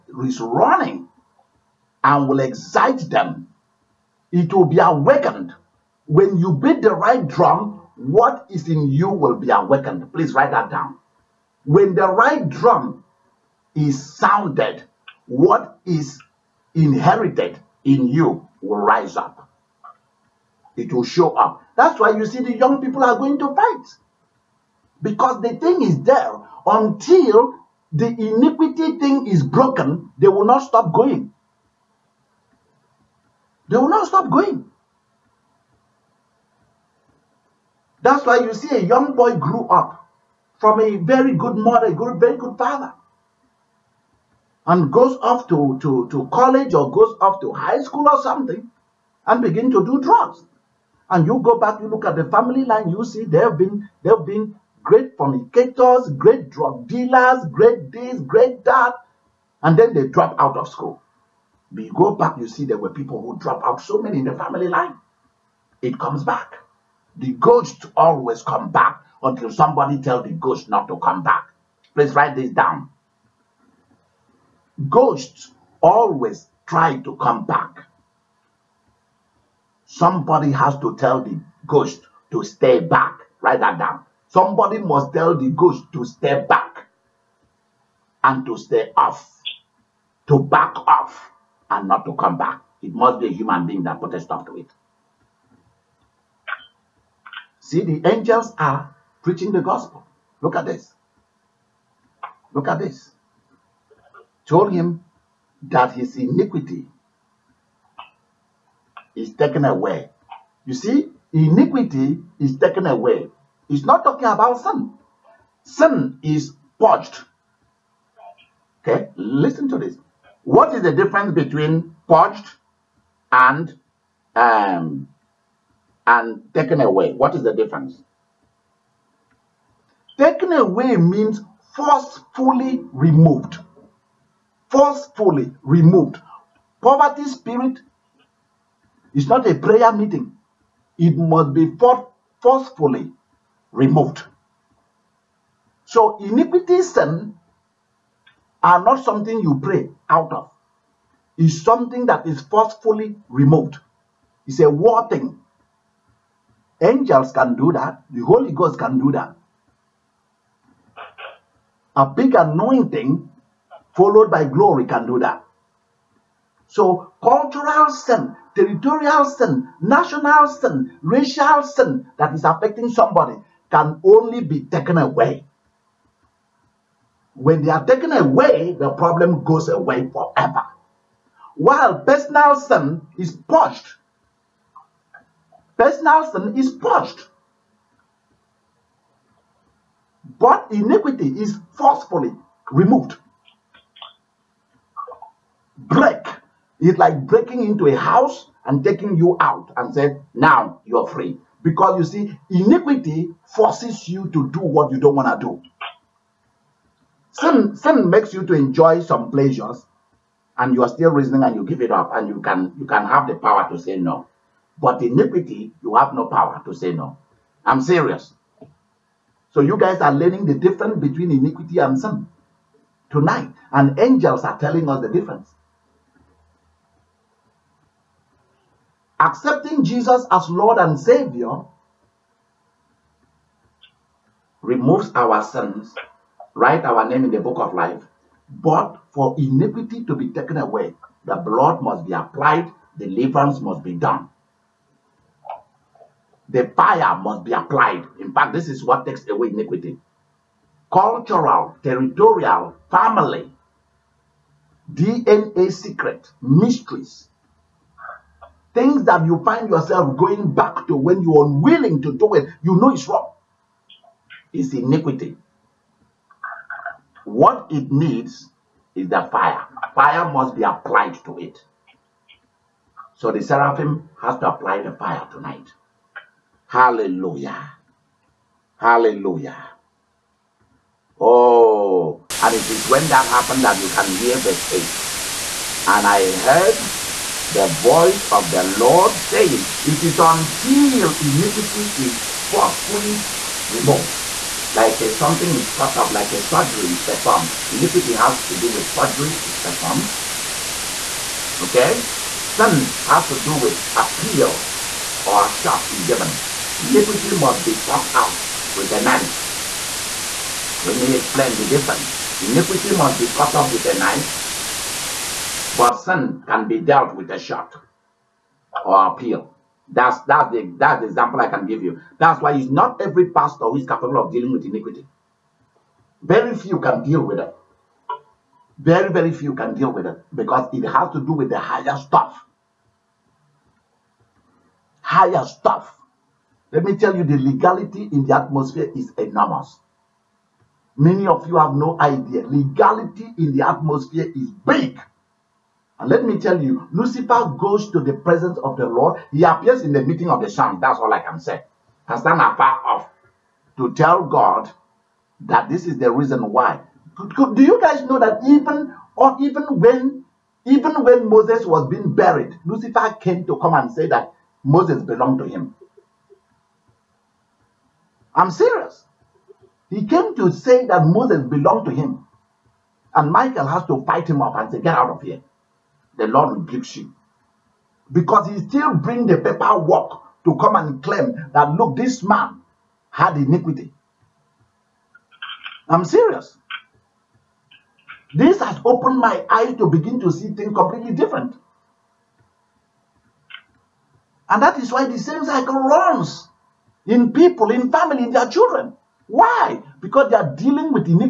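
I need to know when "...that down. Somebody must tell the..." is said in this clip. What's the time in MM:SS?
01:23.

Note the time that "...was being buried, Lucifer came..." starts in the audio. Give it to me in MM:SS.
06:01.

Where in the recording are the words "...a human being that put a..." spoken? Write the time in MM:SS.
01:33.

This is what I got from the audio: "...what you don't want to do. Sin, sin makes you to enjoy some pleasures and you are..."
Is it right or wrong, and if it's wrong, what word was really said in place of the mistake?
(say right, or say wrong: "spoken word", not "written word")
right.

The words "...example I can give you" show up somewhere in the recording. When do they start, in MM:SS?
05:21.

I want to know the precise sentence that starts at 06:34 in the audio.
And that is why the same cycle runs in people, in family, in their children.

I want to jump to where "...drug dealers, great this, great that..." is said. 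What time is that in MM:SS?
00:56.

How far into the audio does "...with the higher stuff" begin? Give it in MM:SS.
05:31.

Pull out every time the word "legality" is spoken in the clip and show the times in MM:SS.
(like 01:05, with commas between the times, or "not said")
05:37, 05:42.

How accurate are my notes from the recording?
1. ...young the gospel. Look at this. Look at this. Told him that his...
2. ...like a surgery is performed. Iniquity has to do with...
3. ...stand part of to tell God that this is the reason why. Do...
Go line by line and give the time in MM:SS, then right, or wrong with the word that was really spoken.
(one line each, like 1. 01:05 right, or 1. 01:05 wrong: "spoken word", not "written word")
1. 01:39 wrong: "preaching", not "young"
2. 04:56 right
3. 05:52 right.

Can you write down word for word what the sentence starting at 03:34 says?
But iniquity, you have no power to say no.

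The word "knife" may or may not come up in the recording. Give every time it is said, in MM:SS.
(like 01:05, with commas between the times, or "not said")
05:09, 05:13.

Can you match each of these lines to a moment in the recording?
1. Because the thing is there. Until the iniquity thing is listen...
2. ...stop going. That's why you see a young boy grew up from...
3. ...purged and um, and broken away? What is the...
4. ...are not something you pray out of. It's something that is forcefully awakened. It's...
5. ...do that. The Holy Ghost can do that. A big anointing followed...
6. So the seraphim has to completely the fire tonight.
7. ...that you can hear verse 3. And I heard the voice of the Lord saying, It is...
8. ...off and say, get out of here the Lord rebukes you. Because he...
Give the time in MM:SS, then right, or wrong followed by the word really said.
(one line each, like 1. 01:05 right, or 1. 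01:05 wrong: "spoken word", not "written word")
1. 00:25 wrong: "broken", not "listen"
2. 00:34 right
3. 02:02 wrong: "taken", not "broken"
4. 02:28 wrong: "removed", not "awakened"
5. 02:37 right
6. 04:33 wrong: "apply", not "completely"
7. 04:43 wrong: "8", not "3"
8. 06:14 right.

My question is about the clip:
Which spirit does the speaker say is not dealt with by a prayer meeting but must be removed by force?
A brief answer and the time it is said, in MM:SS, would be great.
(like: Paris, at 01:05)
Poverty spirit, at 02:16.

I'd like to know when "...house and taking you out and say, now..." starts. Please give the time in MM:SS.
03:17.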